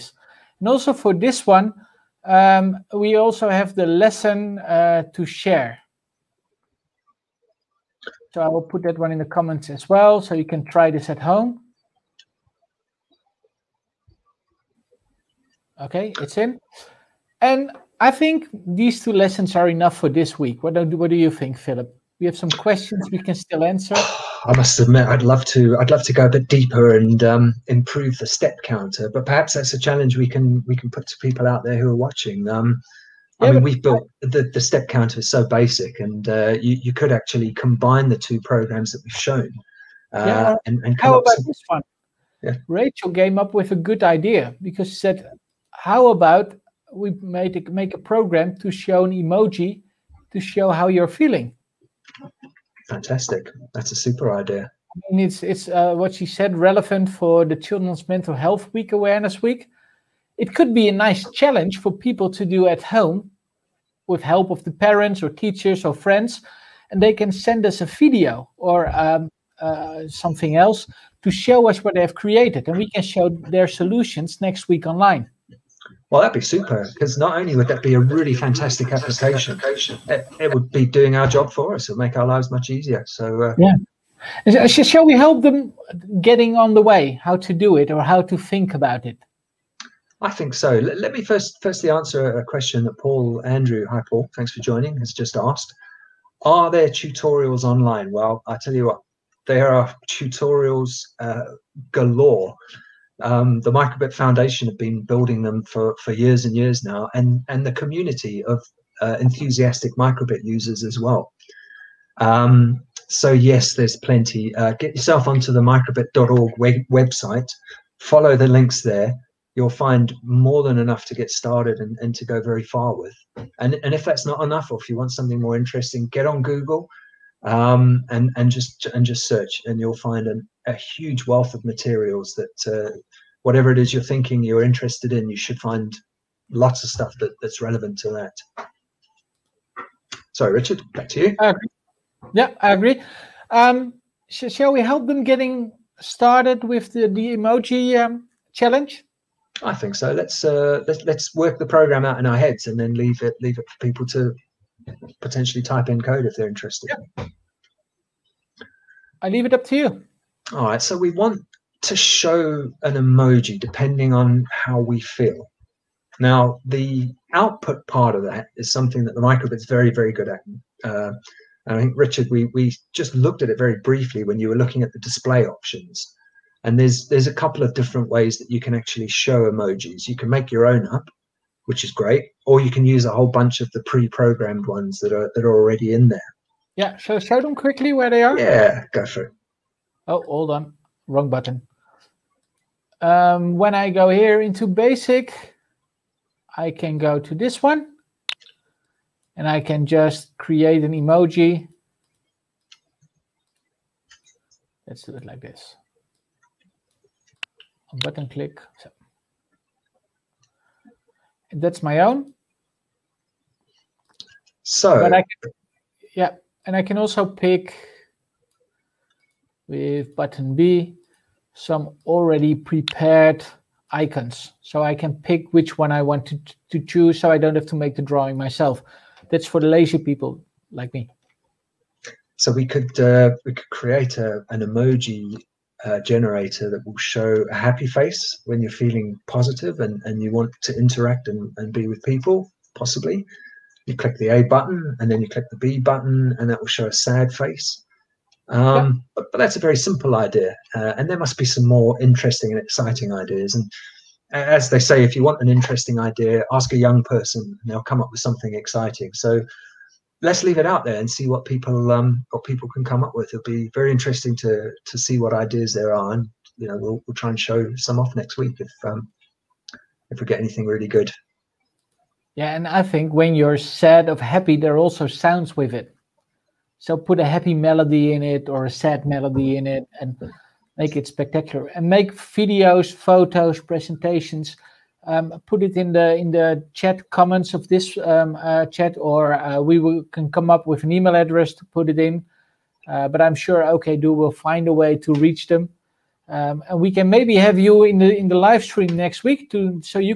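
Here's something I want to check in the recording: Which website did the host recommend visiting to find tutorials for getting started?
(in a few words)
microbit.org.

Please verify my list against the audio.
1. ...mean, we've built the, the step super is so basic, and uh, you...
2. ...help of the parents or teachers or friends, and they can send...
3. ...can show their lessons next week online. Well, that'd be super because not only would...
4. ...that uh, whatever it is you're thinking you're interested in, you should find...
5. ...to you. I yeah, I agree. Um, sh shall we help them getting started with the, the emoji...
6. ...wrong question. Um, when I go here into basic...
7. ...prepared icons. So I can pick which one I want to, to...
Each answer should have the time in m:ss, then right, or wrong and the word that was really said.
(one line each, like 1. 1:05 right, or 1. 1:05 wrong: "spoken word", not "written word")
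1. 0:33 wrong: "counter", not "super"
2. 1:04 right
3. 1:12 wrong: "solutions", not "lessons"
4. 2:12 right
5. 2:21 right
6. 3:11 wrong: "button", not "question"
7. 3:42 right.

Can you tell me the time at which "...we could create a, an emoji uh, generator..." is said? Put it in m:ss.
3:53.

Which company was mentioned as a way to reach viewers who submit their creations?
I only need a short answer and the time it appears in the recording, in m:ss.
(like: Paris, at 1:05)
OKdo, at 4:53.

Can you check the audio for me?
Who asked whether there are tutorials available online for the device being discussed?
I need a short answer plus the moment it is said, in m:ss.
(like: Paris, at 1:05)
Paul Andrew, at 1:32.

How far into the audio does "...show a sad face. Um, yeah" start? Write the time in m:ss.
4:06.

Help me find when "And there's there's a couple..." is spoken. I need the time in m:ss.
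2:56.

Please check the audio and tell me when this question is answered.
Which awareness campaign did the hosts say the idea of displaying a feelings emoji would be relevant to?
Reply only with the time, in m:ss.
0:57.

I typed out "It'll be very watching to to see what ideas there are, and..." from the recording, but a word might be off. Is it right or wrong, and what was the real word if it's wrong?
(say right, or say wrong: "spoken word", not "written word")
wrong: "interesting", not "watching".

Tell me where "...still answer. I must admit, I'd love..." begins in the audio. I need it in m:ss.
0:23.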